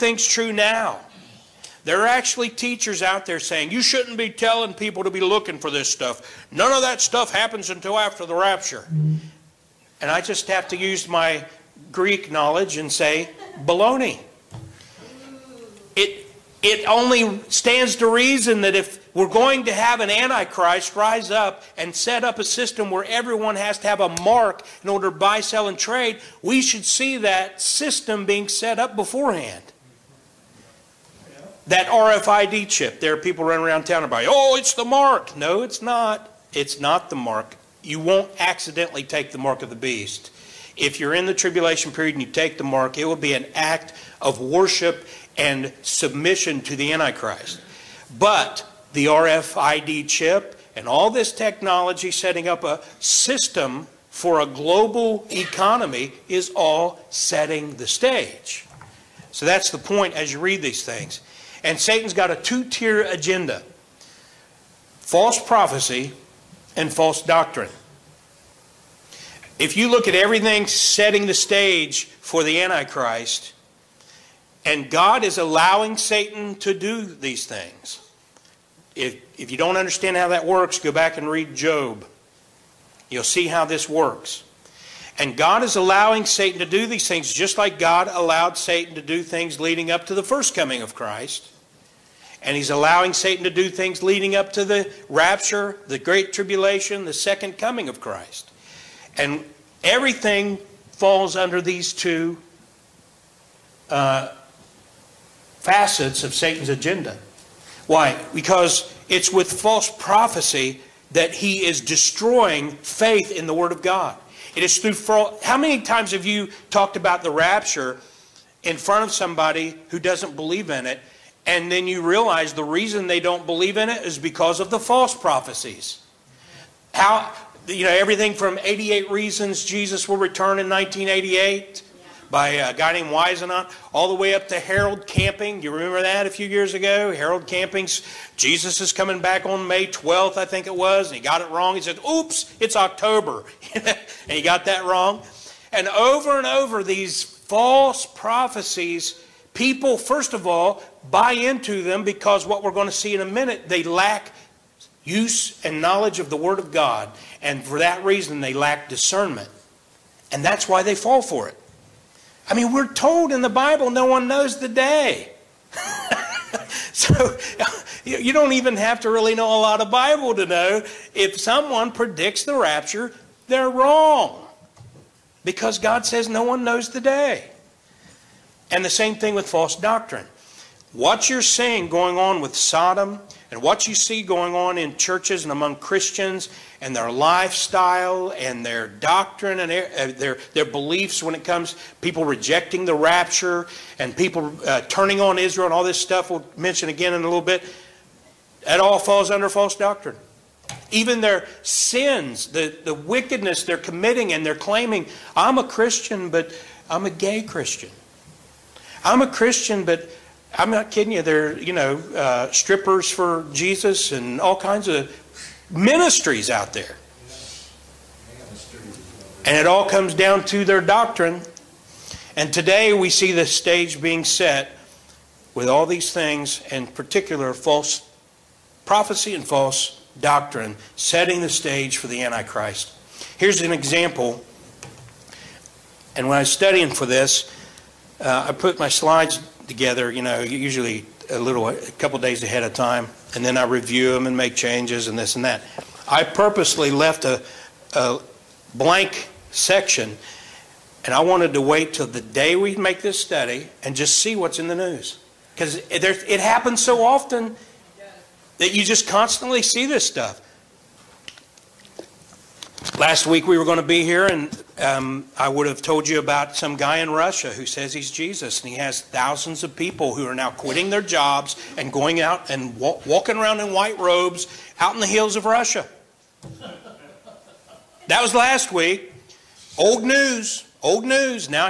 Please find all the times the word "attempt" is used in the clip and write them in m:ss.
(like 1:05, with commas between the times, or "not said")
not said.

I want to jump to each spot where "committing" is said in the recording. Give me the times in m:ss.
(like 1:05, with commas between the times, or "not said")
3:23.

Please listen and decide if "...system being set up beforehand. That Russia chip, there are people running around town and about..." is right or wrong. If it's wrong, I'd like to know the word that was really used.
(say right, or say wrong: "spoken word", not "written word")
wrong: "RFID", not "Russia".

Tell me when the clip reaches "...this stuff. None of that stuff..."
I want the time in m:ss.
0:05.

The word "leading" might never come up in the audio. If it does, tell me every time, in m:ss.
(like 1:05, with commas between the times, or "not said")
1:29, 1:34.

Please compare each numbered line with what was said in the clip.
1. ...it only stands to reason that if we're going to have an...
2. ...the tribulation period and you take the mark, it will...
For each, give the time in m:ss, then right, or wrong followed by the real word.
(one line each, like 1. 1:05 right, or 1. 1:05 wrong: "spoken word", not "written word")
1. 0:16 right
2. 0:41 right.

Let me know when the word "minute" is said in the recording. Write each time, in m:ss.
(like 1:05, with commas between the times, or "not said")
2:33.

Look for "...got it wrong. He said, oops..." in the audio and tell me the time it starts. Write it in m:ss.
2:21.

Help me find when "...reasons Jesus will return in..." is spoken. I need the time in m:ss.
2:09.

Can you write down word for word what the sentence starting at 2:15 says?
You remember that a few years ago?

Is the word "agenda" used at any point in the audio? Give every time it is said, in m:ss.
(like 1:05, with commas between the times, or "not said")
1:03, 1:46.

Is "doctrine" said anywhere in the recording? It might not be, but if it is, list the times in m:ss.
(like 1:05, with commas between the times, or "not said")
1:07, 2:59, 3:08, 3:19, 3:40, 3:50.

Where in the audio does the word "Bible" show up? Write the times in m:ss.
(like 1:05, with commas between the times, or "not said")
2:43, 2:49.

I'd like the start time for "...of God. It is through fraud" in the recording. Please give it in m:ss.
1:53.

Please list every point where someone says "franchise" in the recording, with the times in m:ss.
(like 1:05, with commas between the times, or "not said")
not said.